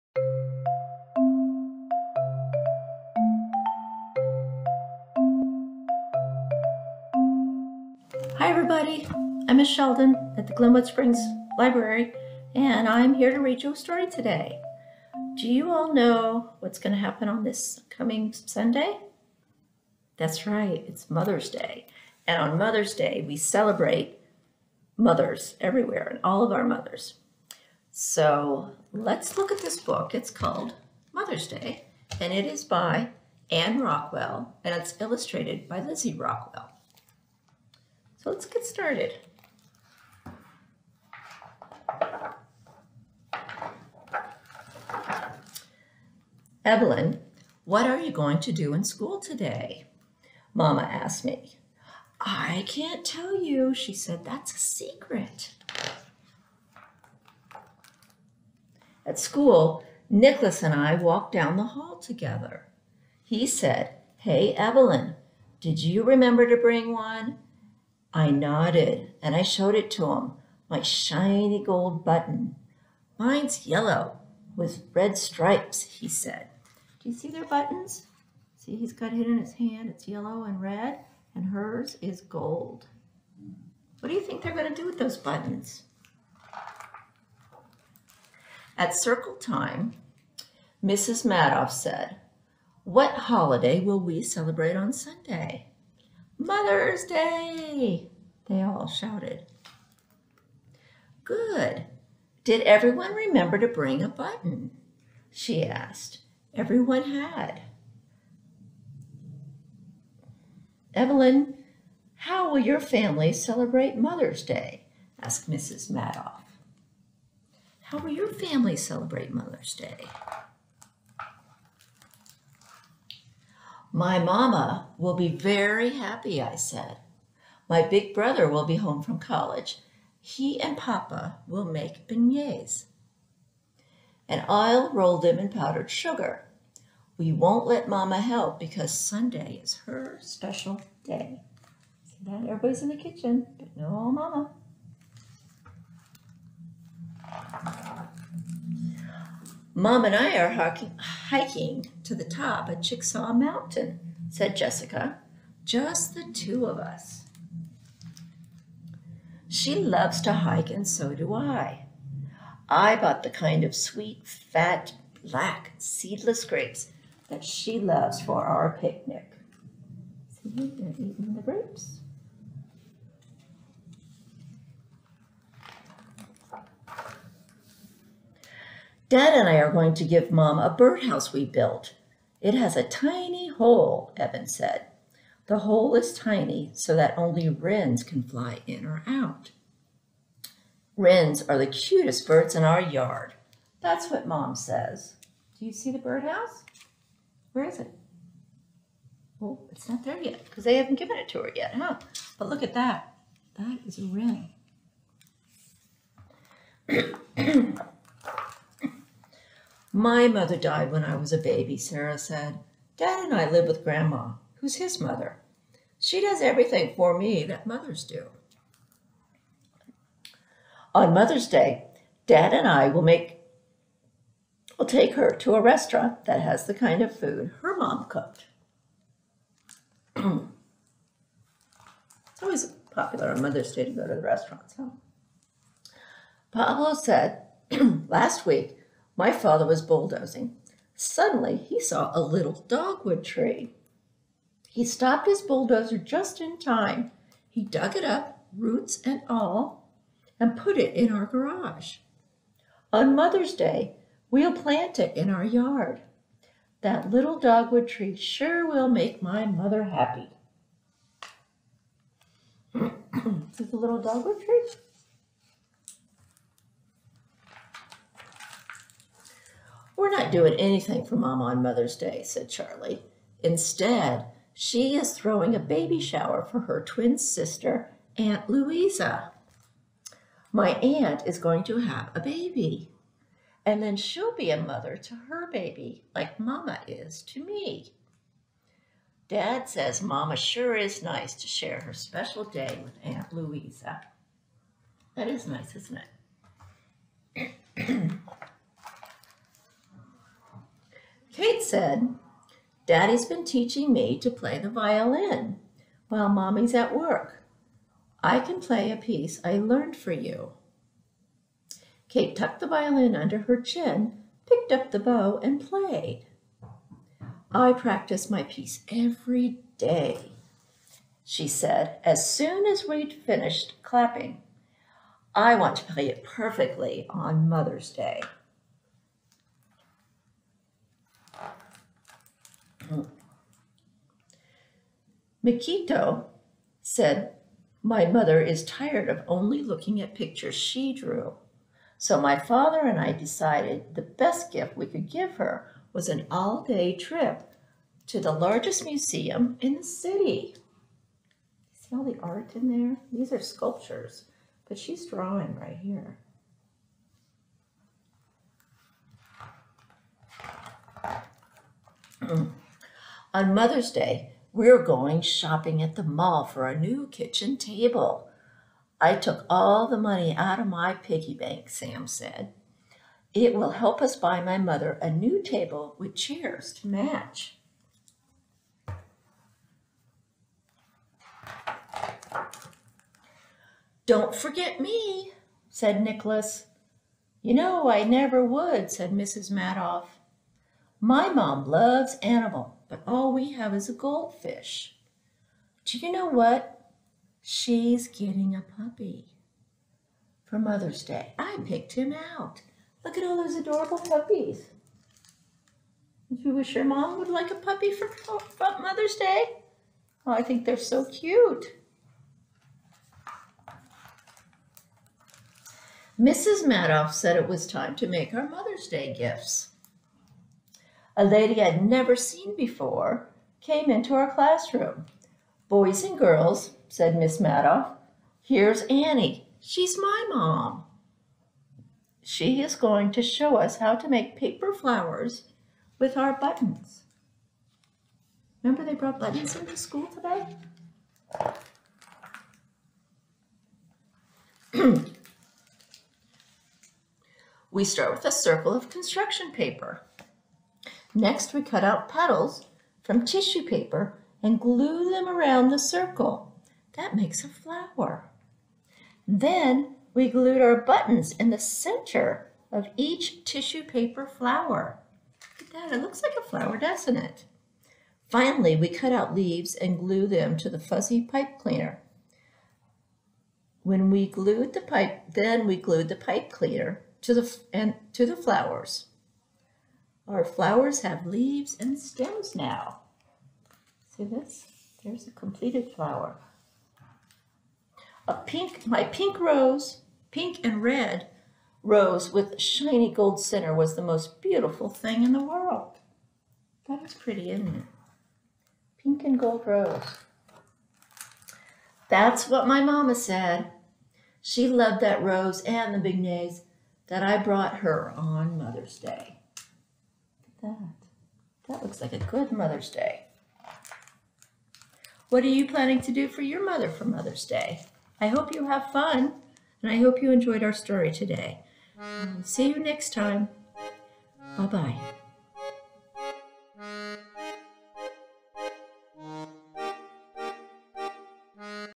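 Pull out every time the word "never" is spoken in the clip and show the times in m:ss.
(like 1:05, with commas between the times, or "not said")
6:28, 7:01.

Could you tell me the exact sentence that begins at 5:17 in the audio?
I practice my piece every day, she said as soon as we'd finished clapping.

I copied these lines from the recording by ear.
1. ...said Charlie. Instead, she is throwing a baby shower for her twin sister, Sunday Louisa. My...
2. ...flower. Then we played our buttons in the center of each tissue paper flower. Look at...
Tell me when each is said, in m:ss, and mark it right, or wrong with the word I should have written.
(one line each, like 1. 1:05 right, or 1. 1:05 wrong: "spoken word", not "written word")
1. 4:32 wrong: "Aunt", not "Sunday"
2. 7:37 wrong: "glued", not "played".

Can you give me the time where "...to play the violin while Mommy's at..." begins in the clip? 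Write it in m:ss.
5:04.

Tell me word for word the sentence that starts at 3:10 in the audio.
Wrens are the cutest birds in our yard.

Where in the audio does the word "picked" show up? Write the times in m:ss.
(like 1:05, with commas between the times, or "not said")
5:14, 6:41.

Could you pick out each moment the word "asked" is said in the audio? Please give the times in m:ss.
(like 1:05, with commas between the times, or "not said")
0:50, 1:45, 1:55.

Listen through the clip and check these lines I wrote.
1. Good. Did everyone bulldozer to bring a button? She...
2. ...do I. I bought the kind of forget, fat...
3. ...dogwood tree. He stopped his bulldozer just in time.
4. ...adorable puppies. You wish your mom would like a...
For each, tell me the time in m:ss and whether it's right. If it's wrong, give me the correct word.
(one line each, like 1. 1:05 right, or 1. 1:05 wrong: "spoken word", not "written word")
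1. 1:41 wrong: "remember", not "bulldozer"
2. 2:41 wrong: "sweet", not "forget"
3. 4:02 right
4. 6:43 right.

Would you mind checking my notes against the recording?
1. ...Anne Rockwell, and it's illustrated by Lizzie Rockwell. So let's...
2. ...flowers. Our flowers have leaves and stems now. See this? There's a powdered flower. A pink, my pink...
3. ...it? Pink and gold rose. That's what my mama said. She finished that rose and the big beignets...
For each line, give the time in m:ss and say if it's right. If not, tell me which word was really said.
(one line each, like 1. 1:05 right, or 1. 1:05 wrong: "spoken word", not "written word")
1. 0:33 right
2. 7:58 wrong: "completed", not "powdered"
3. 8:17 wrong: "loved", not "finished".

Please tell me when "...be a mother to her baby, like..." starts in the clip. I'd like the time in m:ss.
4:44.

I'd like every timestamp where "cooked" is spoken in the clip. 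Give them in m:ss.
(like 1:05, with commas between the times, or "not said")
3:48.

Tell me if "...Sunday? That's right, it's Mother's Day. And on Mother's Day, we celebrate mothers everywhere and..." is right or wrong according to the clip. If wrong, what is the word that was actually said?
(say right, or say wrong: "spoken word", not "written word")
right.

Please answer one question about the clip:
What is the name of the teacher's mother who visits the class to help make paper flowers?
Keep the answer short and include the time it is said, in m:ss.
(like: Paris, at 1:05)
Annie, at 7:08.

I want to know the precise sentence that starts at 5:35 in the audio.
Michiko said, My mother is tired of only looking at pictures she drew.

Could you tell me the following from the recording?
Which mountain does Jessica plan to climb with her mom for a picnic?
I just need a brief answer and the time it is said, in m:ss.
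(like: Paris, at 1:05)
Chicksaw Mountain, at 2:32.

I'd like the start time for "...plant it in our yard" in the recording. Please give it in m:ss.
4:14.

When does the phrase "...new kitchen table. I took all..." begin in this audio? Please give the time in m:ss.
6:06.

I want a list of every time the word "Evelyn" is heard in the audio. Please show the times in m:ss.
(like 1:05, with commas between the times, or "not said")
0:46, 1:04, 1:50.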